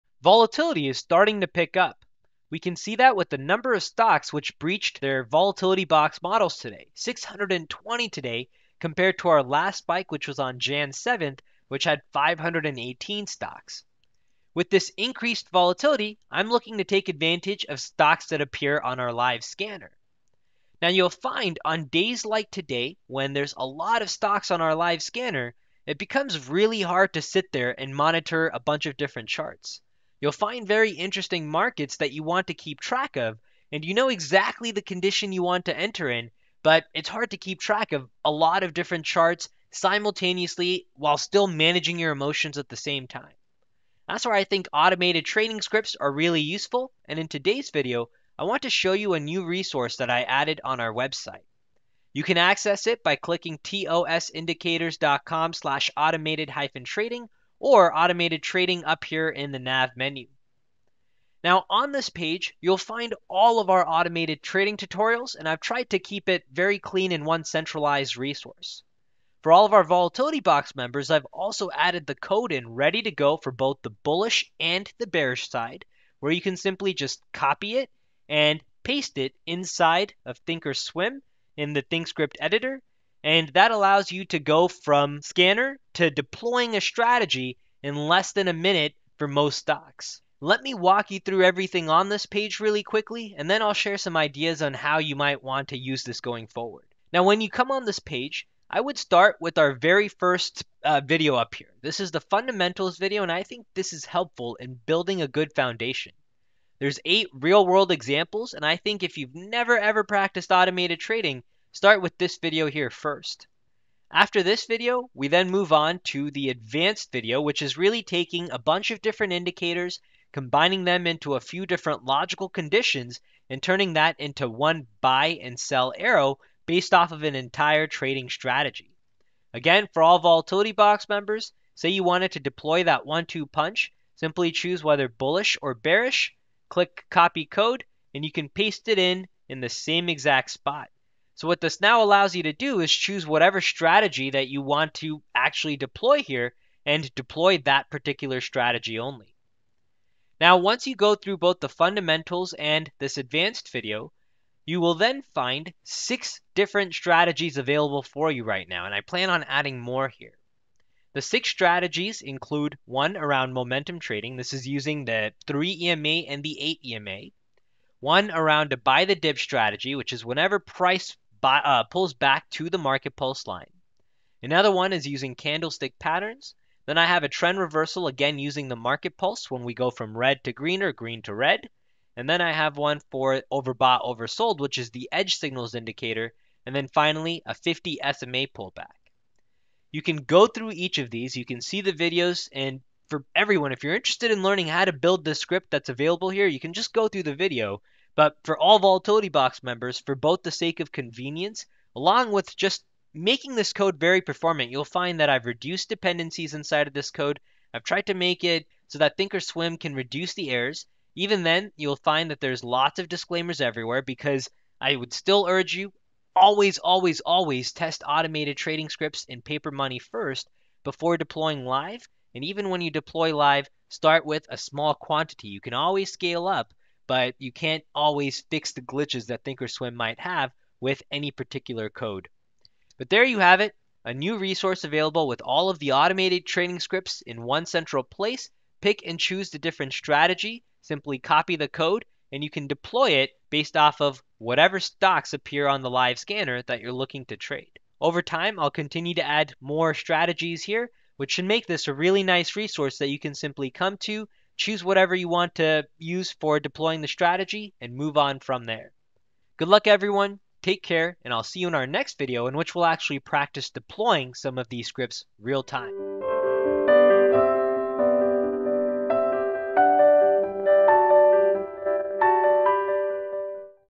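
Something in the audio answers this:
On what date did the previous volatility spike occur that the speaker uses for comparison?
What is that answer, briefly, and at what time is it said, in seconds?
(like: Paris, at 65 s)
Jan 7th, at 10 s.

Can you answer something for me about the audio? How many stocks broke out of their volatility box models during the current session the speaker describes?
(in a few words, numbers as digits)
620.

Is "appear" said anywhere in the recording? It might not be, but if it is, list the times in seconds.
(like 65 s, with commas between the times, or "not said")
18 s, 245 s.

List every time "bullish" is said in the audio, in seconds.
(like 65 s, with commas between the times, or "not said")
74 s, 135 s.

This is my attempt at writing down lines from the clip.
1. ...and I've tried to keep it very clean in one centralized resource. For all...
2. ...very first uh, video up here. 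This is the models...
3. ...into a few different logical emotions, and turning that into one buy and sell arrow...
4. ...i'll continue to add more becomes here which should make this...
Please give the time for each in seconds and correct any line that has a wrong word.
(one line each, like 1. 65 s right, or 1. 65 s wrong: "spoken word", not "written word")
1. 65 s right
2. 99 s wrong: "fundamentals", not "models"
3. 121 s wrong: "conditions", not "emotions"
4. 248 s wrong: "strategies", not "becomes".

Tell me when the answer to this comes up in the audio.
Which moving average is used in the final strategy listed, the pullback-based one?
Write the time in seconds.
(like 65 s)
187 s.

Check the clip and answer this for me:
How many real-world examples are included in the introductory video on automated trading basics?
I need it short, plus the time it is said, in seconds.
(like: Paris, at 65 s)
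8, at 107 s.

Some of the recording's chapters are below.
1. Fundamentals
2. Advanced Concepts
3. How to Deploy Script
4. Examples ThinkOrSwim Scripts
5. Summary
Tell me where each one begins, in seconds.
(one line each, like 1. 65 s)
1. 43 s
2. 116 s
3. 155 s
4. 165 s
5. 240 s.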